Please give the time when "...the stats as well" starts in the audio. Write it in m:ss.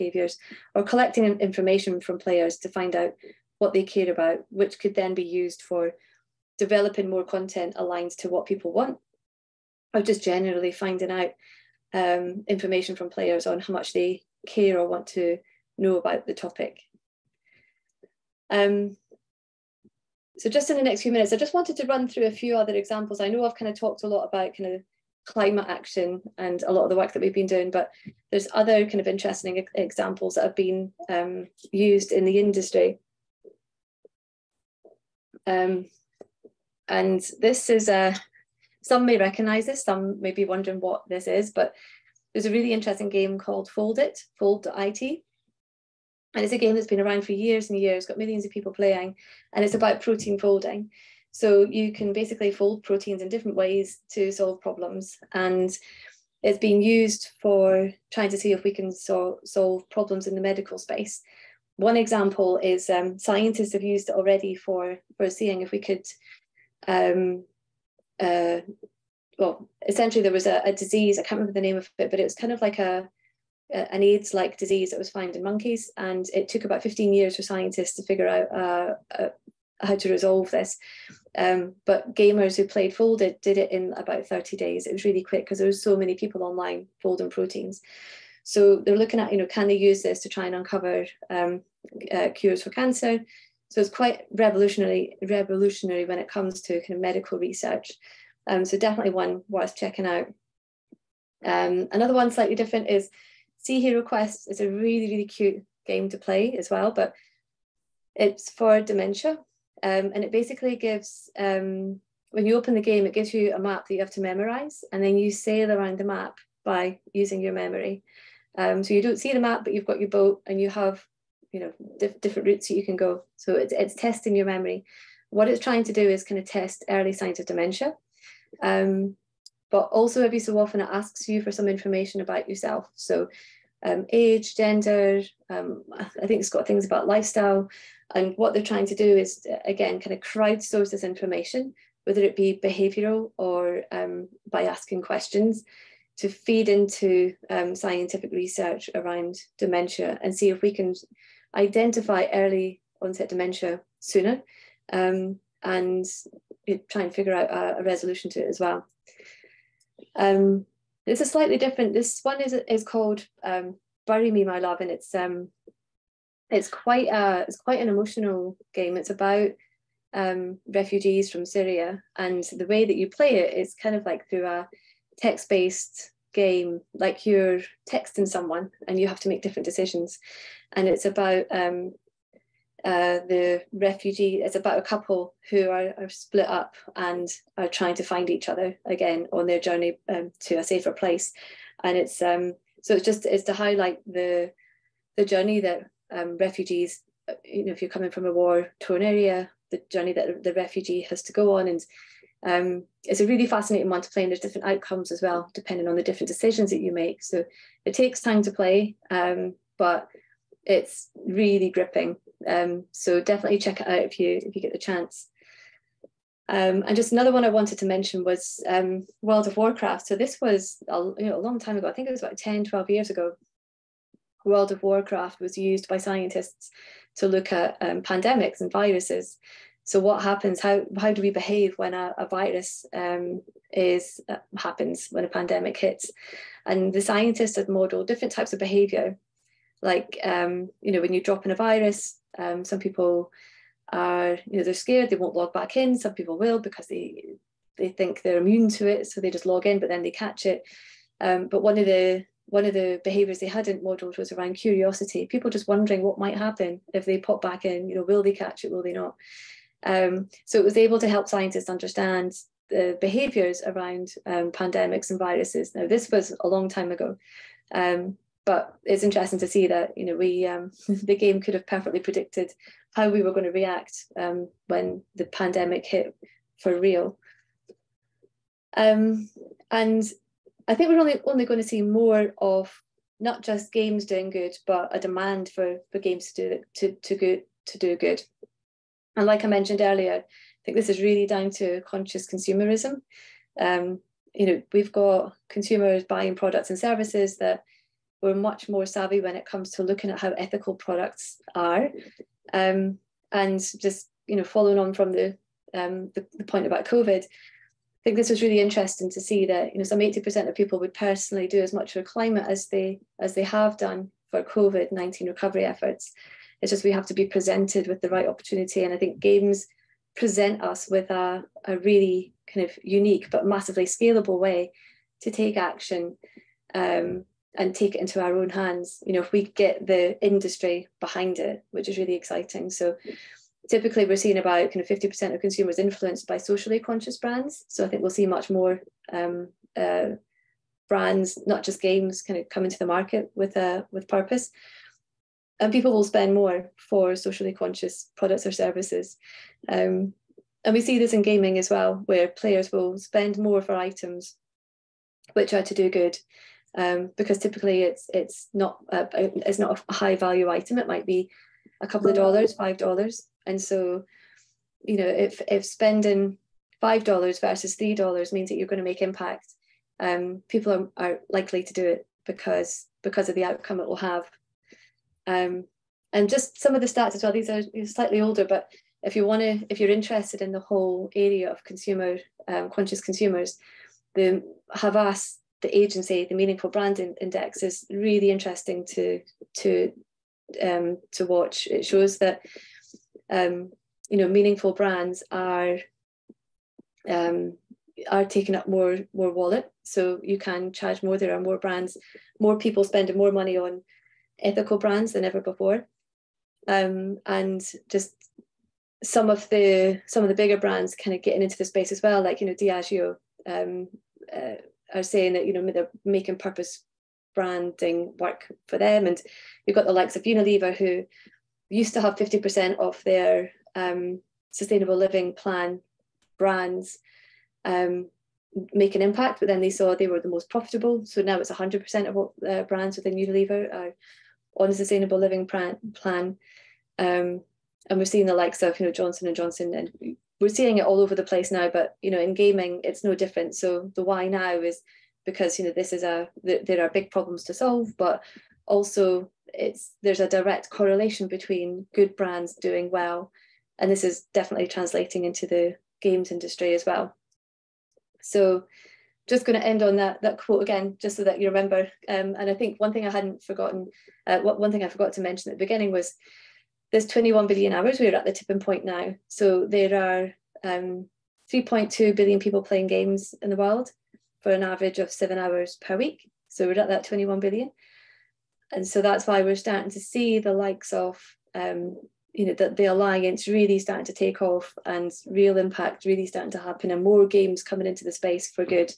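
6:16.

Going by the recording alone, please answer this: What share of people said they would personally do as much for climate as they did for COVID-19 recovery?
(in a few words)
80%.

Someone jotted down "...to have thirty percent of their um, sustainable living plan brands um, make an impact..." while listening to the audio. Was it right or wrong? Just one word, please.
wrong.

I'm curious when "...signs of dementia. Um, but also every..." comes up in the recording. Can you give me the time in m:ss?
2:07.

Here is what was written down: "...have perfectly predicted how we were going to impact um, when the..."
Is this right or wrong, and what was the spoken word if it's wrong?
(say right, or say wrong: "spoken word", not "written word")
wrong: "react", not "impact".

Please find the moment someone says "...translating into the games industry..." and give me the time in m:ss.
7:34.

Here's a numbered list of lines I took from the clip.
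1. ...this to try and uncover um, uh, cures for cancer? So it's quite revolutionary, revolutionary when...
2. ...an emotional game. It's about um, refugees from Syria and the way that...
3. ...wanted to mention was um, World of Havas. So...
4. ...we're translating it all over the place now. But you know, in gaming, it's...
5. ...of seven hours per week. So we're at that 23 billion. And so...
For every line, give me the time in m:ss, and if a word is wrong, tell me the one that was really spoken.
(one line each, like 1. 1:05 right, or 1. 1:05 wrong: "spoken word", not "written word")
1. 1:30 right
2. 2:47 right
3. 3:37 wrong: "Warcraft", not "Havas"
4. 7:20 wrong: "seeing", not "translating"
5. 7:54 wrong: "21", not "23".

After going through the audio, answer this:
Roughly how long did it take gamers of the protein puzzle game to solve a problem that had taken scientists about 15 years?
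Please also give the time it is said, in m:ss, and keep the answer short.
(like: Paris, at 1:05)
30 days, at 1:24.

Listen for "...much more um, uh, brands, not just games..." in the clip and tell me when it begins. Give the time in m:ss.
5:38.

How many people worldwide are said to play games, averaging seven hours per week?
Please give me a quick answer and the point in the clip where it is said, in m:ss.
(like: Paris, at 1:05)
3.2 billion, at 7:51.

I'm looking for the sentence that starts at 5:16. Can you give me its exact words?
It's just we have to be presented with the right opportunity.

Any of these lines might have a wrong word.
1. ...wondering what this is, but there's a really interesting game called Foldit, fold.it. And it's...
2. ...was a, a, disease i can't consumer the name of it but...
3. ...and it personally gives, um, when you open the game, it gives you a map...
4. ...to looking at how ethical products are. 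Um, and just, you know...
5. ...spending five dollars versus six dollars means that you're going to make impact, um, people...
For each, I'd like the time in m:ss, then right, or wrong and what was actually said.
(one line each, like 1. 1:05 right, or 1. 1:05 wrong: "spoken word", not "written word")
1. 0:40 right
2. 1:10 wrong: "remember", not "consumer"
3. 1:50 wrong: "basically", not "personally"
4. 4:59 right
5. 6:05 wrong: "three", not "six".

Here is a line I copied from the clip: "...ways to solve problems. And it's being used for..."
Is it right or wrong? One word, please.
right.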